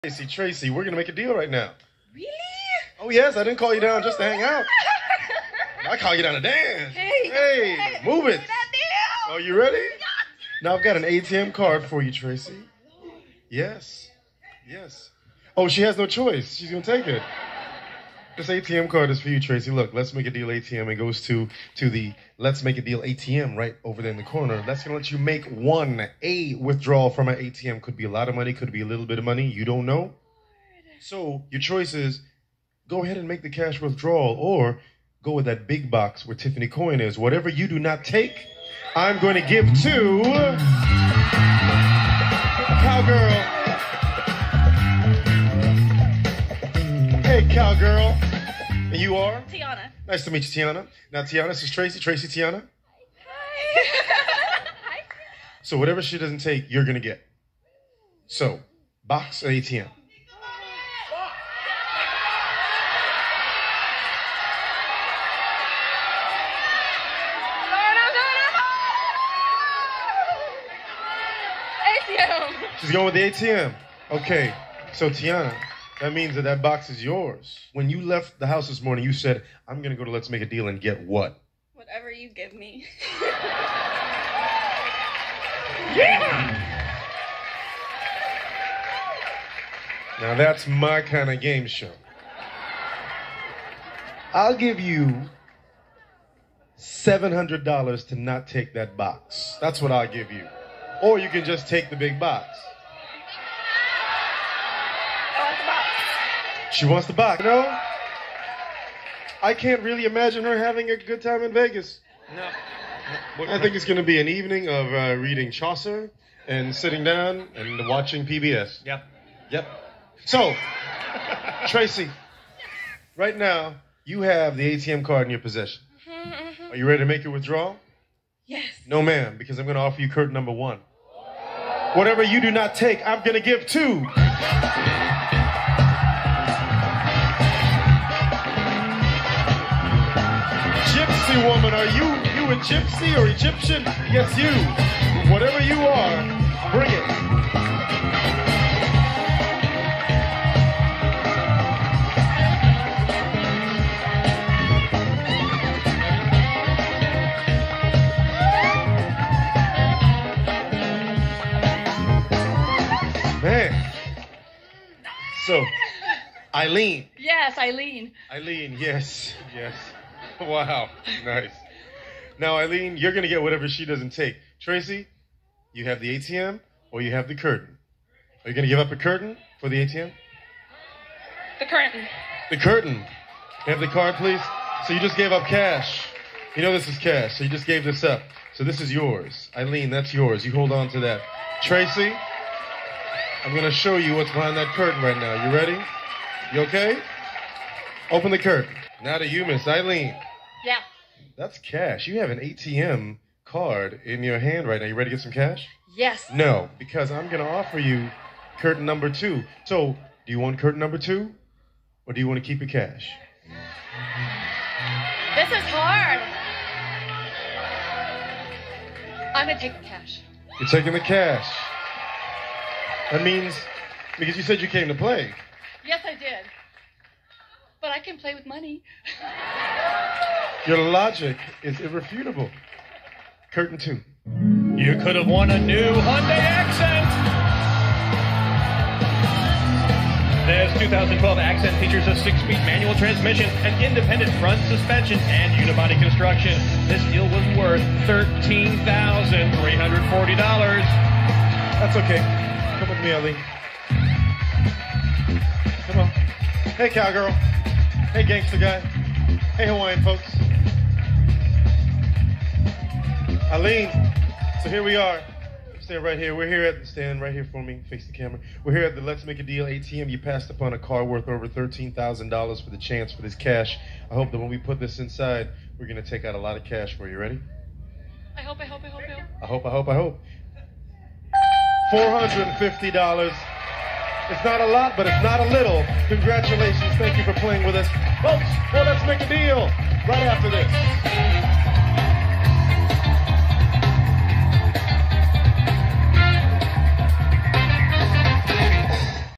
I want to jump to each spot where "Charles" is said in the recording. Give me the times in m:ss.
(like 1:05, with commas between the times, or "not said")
not said.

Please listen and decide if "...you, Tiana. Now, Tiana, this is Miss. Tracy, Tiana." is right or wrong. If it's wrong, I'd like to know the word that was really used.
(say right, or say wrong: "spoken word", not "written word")
wrong: "Tracy", not "Miss".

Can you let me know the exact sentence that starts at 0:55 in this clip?
so whatever she doesn't take, you're going to get.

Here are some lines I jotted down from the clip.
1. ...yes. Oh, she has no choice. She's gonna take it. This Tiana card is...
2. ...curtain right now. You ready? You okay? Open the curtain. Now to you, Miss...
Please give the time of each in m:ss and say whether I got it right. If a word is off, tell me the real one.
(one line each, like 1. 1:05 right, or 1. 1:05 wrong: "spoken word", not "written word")
1. 0:14 wrong: "ATM", not "Tiana"
2. 3:14 right.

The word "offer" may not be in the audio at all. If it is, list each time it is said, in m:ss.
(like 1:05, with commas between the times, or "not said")
2:09, 3:27.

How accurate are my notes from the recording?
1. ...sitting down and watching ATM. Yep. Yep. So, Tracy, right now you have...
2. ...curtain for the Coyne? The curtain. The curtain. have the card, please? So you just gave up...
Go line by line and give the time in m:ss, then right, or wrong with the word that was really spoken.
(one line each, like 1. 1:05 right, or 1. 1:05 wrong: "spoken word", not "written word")
1. 1:56 wrong: "PBS", not "ATM"
2. 2:58 wrong: "ATM", not "Coyne".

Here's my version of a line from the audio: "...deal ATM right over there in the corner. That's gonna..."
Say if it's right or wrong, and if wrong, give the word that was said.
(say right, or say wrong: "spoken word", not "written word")
right.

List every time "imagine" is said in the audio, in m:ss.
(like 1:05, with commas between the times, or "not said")
1:50.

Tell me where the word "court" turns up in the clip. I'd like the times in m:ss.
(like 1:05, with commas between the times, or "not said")
not said.